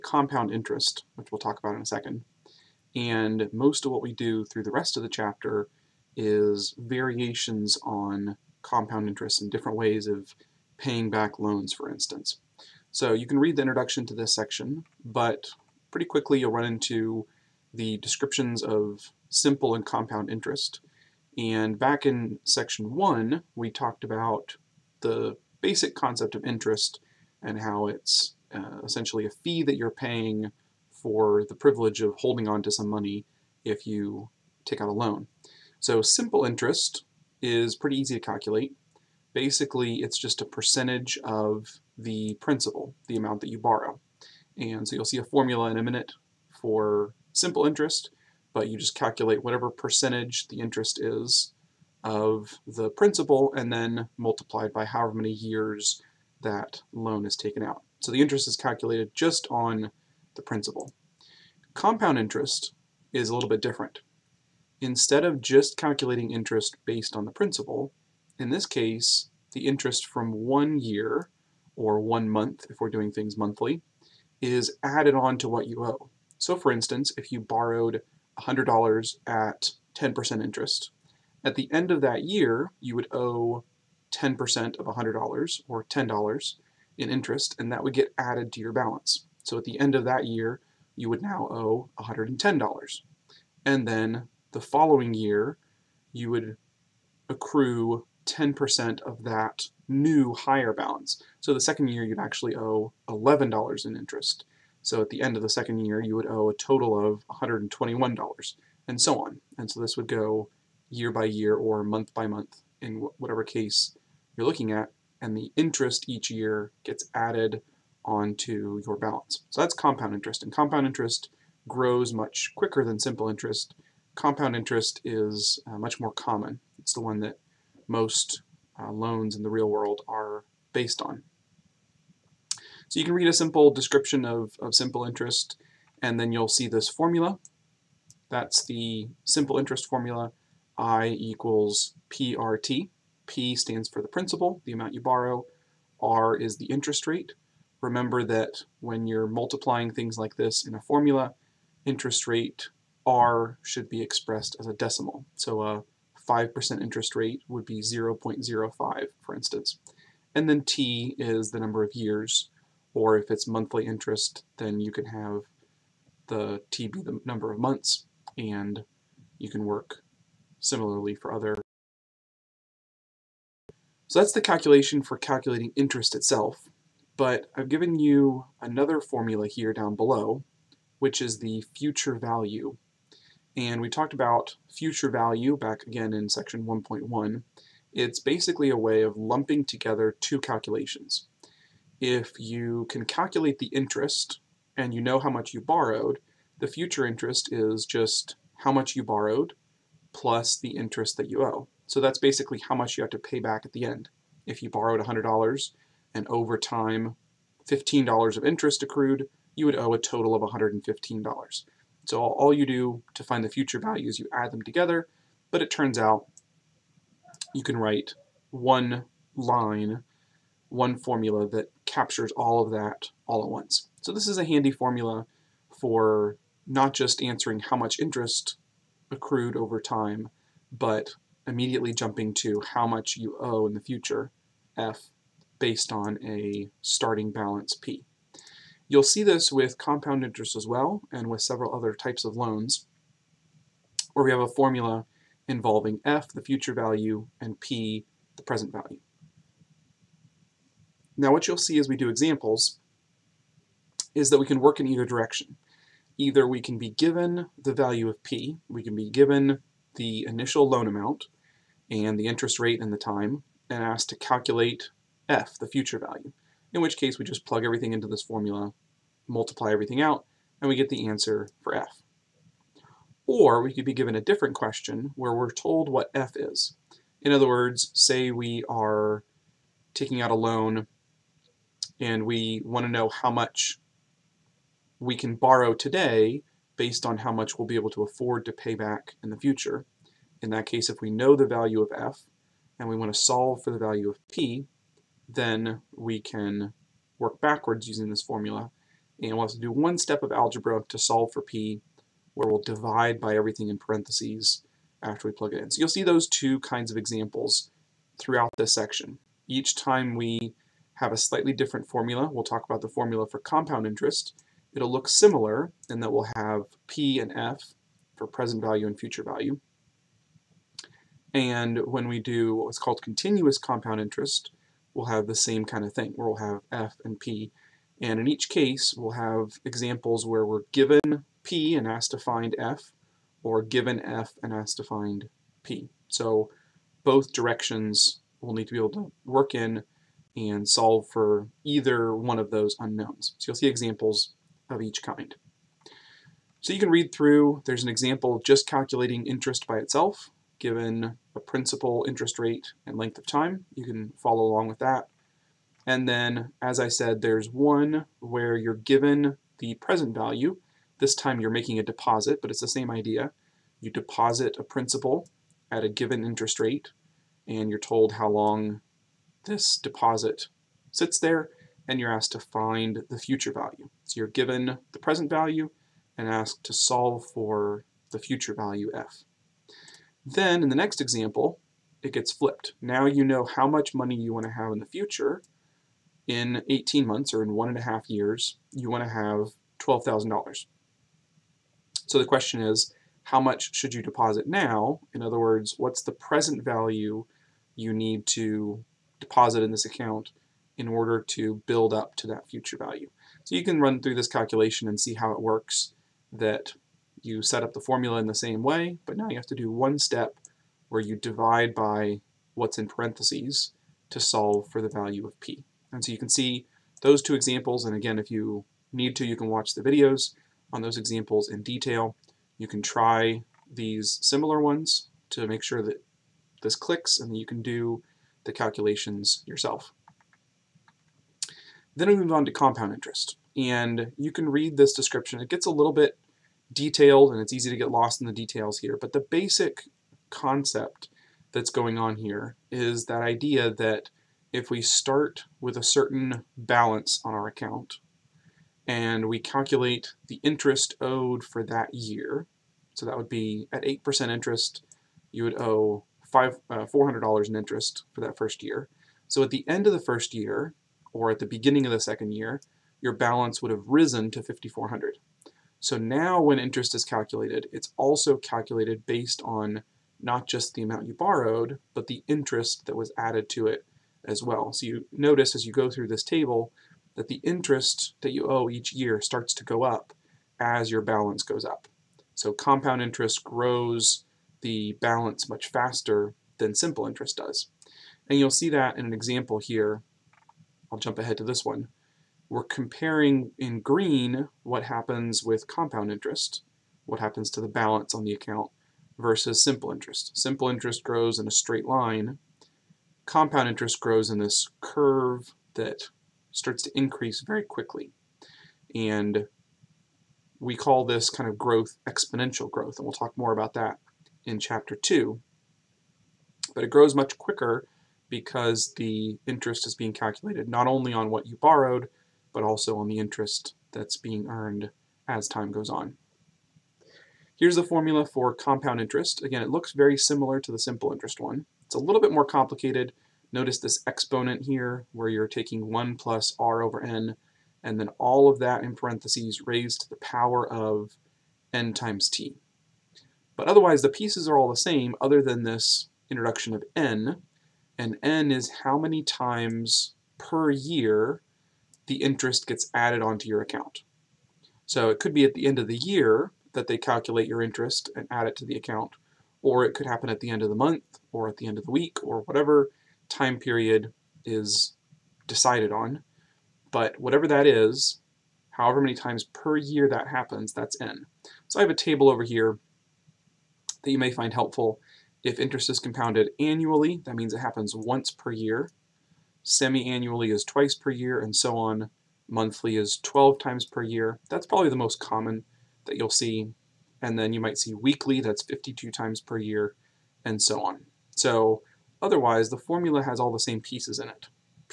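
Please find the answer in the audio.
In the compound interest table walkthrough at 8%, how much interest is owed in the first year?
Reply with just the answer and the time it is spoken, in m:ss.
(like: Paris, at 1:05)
$400, at 7:36.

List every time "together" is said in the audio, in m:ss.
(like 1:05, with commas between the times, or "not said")
3:09, 3:34.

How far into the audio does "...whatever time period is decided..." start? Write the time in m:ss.
9:22.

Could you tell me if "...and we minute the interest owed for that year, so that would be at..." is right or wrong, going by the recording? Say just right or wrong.
wrong.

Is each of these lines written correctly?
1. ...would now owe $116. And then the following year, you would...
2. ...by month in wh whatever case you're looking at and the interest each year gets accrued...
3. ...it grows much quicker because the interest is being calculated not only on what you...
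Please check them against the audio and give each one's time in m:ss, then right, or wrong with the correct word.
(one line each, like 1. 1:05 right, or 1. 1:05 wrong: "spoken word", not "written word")
1. 1:31 wrong: "110", not "116"
2. 1:52 wrong: "added", not "accrued"
3. 8:36 right.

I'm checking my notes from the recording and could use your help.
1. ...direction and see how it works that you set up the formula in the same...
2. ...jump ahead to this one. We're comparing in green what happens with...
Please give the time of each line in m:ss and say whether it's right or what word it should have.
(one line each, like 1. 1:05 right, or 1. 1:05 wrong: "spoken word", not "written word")
1. 6:44 wrong: "calculation", not "direction"
2. 8:10 right.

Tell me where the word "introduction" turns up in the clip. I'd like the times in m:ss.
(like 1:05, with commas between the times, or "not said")
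0:13, 9:06.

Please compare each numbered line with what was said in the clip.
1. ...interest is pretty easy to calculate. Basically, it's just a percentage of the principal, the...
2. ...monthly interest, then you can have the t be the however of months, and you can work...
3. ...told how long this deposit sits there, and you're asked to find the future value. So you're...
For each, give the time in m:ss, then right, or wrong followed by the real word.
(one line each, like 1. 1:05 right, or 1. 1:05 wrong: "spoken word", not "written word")
1. 0:36 right
2. 2:43 wrong: "number", not "however"
3. 6:07 right.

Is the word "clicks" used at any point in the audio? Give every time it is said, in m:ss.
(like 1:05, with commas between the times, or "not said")
7:06.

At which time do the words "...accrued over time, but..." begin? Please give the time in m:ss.
3:49.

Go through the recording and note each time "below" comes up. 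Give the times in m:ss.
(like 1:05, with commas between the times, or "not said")
2:59.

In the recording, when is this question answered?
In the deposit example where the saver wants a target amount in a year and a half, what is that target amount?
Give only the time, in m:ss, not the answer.
6:29.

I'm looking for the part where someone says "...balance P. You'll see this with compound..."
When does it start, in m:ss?
3:57.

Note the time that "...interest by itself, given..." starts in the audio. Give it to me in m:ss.
5:49.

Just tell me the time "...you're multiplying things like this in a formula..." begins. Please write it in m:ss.
2:29.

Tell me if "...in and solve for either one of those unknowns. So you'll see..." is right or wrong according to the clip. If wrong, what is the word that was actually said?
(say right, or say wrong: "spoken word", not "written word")
right.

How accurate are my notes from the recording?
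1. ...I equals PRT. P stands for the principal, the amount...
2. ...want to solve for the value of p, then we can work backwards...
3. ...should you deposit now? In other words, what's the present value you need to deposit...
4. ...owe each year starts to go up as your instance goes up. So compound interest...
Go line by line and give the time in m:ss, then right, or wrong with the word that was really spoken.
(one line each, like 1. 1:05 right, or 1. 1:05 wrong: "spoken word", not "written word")
1. 2:20 right
2. 4:52 right
3. 6:33 right
4. 7:58 wrong: "balance", not "instance".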